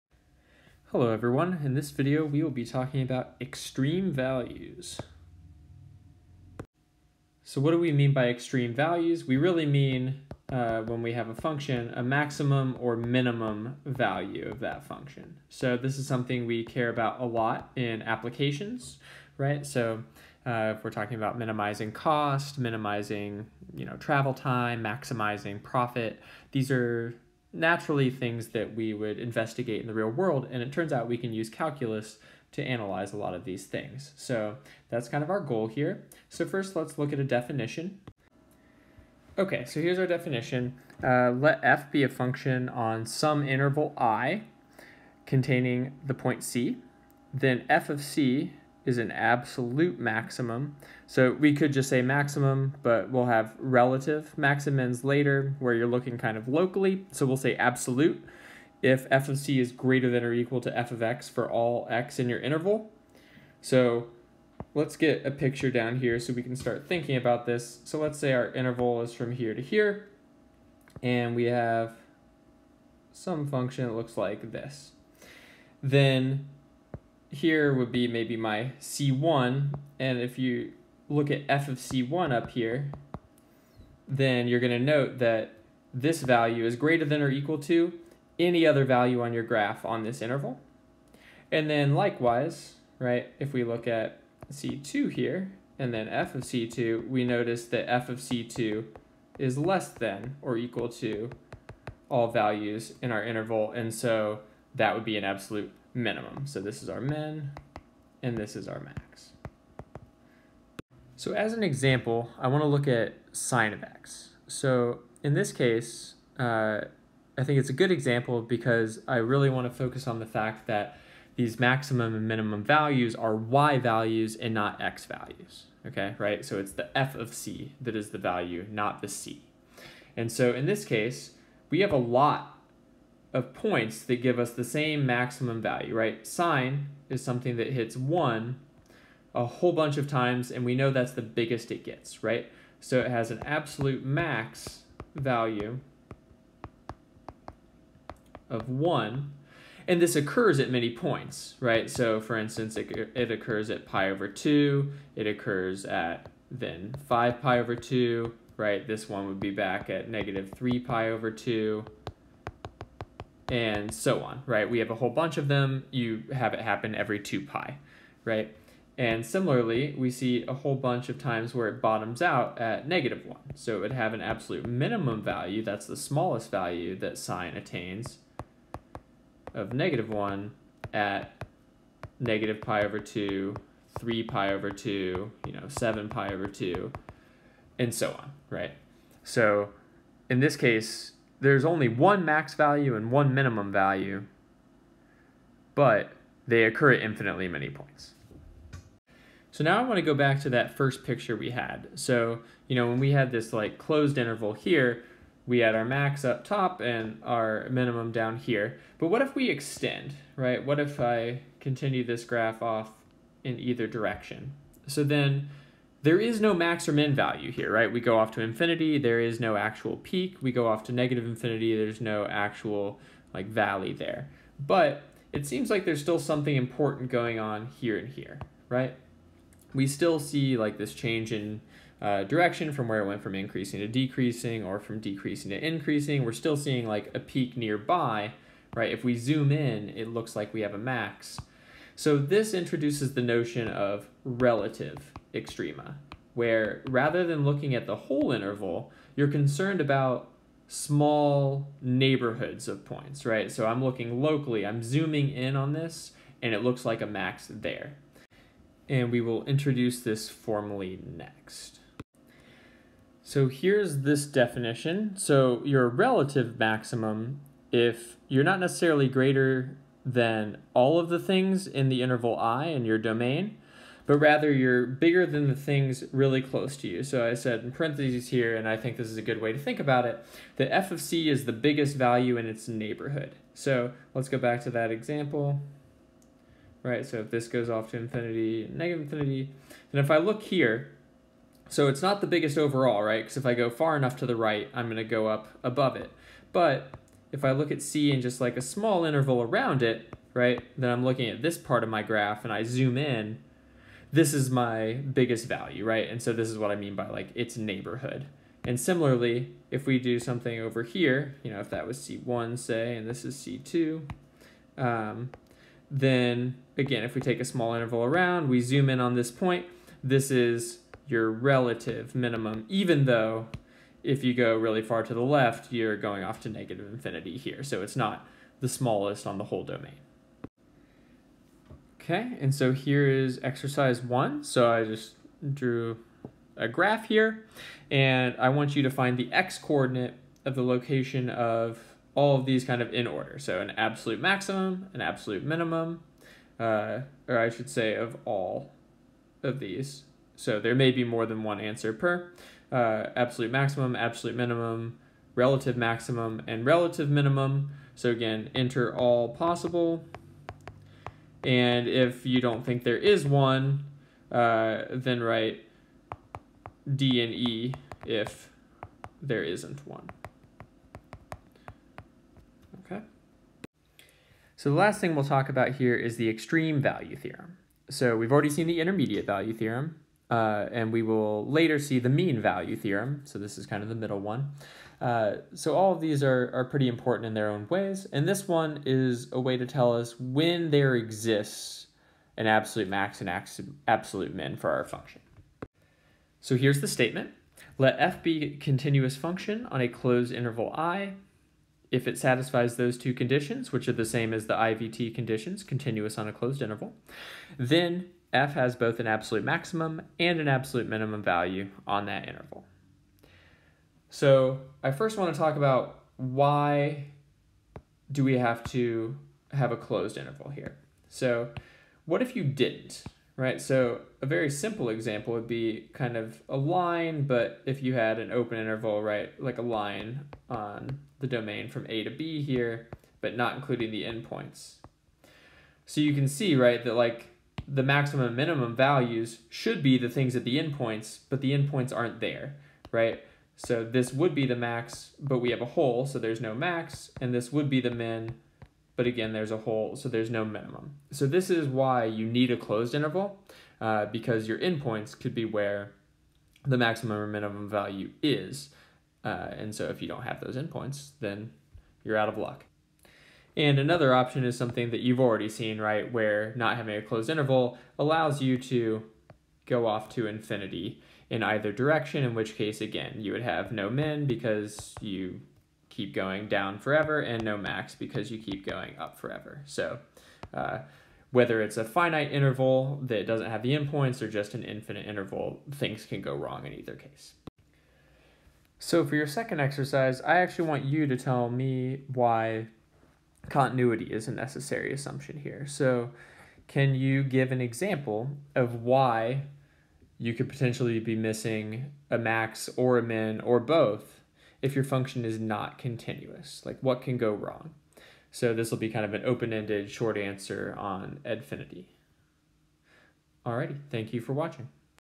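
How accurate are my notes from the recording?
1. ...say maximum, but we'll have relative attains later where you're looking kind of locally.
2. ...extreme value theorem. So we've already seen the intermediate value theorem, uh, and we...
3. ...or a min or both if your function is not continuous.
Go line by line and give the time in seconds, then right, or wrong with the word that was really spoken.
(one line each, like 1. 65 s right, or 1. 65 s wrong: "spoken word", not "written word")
1. 51 s wrong: "maximins", not "attains"
2. 376 s right
3. 502 s right.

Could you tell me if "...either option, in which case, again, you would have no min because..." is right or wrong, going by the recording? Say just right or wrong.
wrong.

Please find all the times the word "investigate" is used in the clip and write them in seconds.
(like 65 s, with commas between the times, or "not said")
29 s.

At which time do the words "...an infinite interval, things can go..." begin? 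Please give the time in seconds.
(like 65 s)
484 s.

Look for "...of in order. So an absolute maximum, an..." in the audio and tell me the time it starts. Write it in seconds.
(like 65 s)
342 s.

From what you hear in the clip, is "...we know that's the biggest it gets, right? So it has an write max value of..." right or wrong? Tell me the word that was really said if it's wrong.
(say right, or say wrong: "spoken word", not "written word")
wrong: "absolute", not "write".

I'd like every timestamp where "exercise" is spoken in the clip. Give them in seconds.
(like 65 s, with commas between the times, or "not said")
333 s, 489 s.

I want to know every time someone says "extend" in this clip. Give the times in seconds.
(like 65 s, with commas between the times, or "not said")
209 s.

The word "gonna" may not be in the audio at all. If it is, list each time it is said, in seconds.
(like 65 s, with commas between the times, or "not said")
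294 s.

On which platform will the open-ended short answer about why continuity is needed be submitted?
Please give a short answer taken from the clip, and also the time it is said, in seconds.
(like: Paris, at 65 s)
Edfinity, at 511 s.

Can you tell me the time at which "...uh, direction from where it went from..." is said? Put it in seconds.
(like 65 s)
232 s.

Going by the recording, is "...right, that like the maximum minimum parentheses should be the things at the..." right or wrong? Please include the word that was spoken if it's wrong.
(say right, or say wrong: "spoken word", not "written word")
wrong: "values", not "parentheses".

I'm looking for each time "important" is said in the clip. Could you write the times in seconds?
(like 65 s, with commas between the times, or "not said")
226 s, 386 s.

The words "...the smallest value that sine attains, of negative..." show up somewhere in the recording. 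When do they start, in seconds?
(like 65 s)
175 s.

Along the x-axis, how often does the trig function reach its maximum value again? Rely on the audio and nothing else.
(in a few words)
every 2 pi.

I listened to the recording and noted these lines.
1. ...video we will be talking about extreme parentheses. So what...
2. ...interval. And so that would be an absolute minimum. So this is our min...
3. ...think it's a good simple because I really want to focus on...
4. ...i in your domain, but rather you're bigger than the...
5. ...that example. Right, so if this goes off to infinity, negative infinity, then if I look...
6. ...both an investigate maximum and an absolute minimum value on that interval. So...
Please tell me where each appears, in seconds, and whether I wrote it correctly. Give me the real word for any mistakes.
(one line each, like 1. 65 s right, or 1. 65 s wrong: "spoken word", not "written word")
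1. 1 s wrong: "values", not "parentheses"
2. 103 s right
3. 117 s wrong: "example", not "simple"
4. 272 s right
5. 284 s right
6. 408 s wrong: "absolute", not "investigate".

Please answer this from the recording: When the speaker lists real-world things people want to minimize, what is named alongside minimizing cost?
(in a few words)
travel time.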